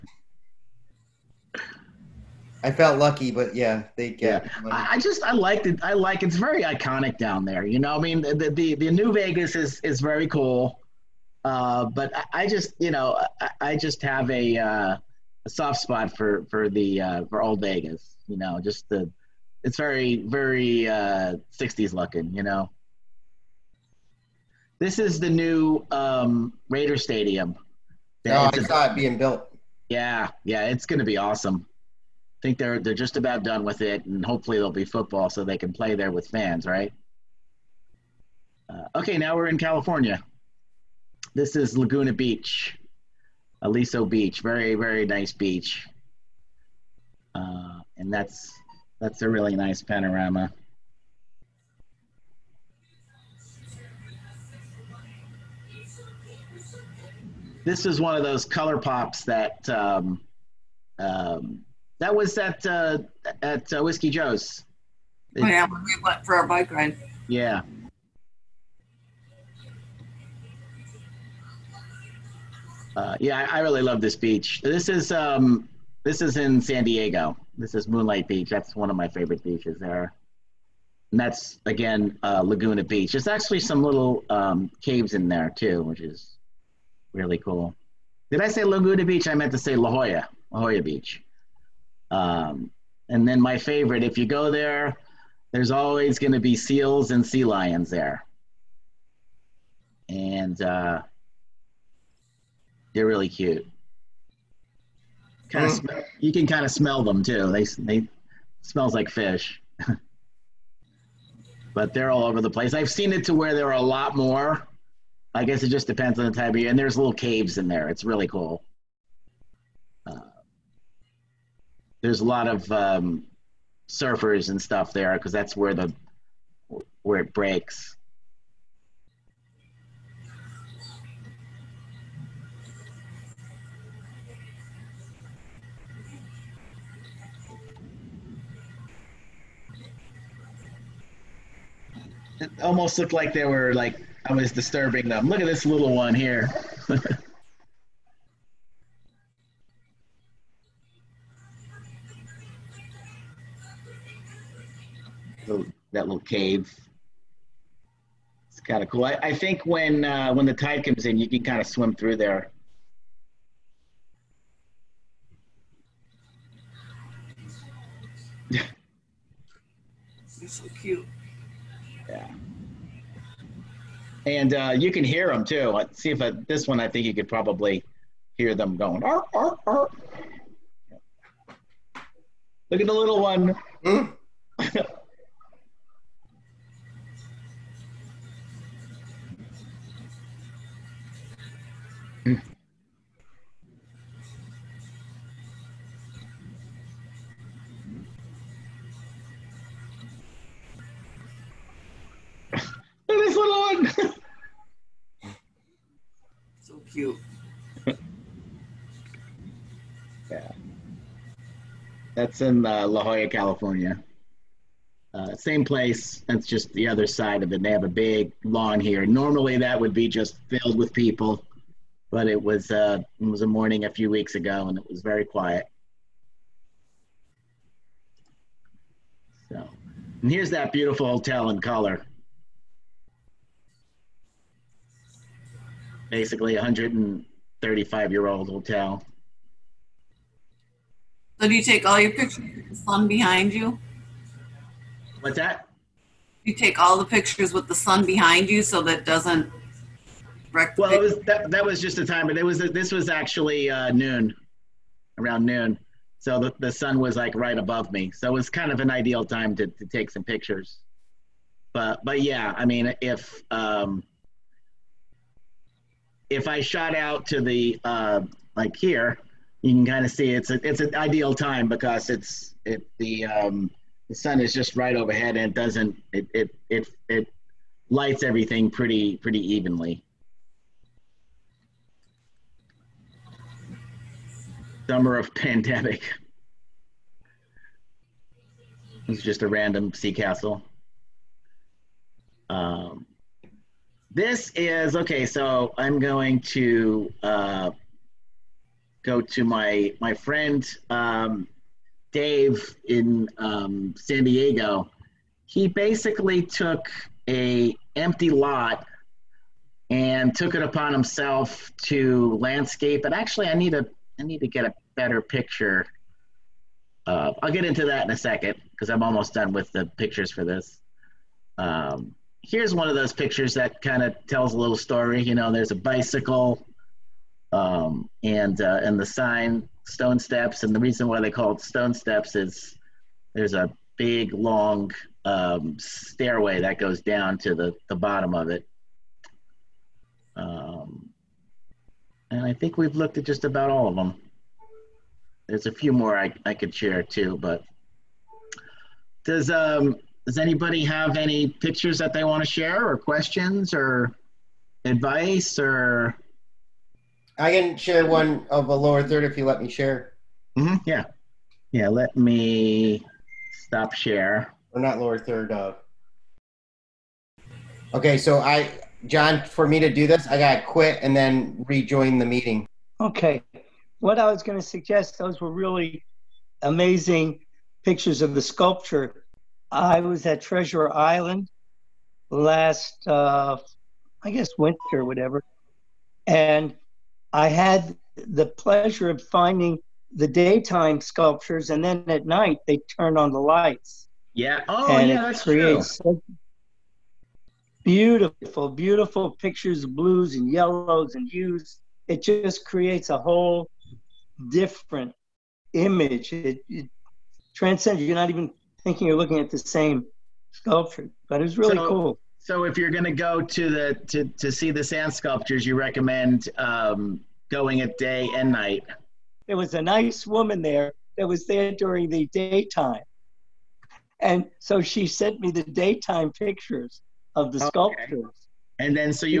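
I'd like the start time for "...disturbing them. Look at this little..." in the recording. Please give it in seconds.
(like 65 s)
144 s.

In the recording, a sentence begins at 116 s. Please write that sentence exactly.
And there's little caves in there.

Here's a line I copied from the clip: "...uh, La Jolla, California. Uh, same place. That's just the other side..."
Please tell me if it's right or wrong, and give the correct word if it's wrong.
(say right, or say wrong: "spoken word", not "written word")
right.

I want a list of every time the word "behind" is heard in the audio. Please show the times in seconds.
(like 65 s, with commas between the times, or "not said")
243 s, 248 s.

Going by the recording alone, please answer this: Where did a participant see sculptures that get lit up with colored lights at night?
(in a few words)
Treasure Island.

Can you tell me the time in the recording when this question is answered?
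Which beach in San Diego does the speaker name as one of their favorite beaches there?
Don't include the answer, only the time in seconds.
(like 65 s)
77 s.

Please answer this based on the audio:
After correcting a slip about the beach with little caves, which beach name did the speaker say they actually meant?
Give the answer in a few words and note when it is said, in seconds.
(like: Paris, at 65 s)
La Jolla Beach, at 89 s.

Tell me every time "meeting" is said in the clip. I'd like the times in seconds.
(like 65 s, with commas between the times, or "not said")
372 s.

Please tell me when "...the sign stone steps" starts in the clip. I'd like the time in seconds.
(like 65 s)
328 s.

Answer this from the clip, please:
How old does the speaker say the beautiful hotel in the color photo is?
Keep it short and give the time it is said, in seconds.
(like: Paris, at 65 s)
135 years, at 236 s.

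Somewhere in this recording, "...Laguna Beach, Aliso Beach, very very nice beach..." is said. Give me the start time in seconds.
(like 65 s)
41 s.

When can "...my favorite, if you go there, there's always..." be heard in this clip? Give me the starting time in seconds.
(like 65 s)
93 s.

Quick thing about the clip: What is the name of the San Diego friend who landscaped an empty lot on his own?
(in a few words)
Dave.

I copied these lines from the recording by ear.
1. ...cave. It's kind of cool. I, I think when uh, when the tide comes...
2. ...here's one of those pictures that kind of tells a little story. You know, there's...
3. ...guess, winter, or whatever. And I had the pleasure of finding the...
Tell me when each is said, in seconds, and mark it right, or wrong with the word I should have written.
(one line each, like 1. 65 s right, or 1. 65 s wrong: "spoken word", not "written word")
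1. 156 s right
2. 322 s right
3. 384 s right.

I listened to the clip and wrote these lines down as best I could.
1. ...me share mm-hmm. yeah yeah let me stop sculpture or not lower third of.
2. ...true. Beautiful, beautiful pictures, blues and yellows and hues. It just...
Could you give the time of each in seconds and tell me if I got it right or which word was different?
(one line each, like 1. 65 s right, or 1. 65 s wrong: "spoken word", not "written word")
1. 359 s wrong: "share", not "sculpture"
2. 395 s right.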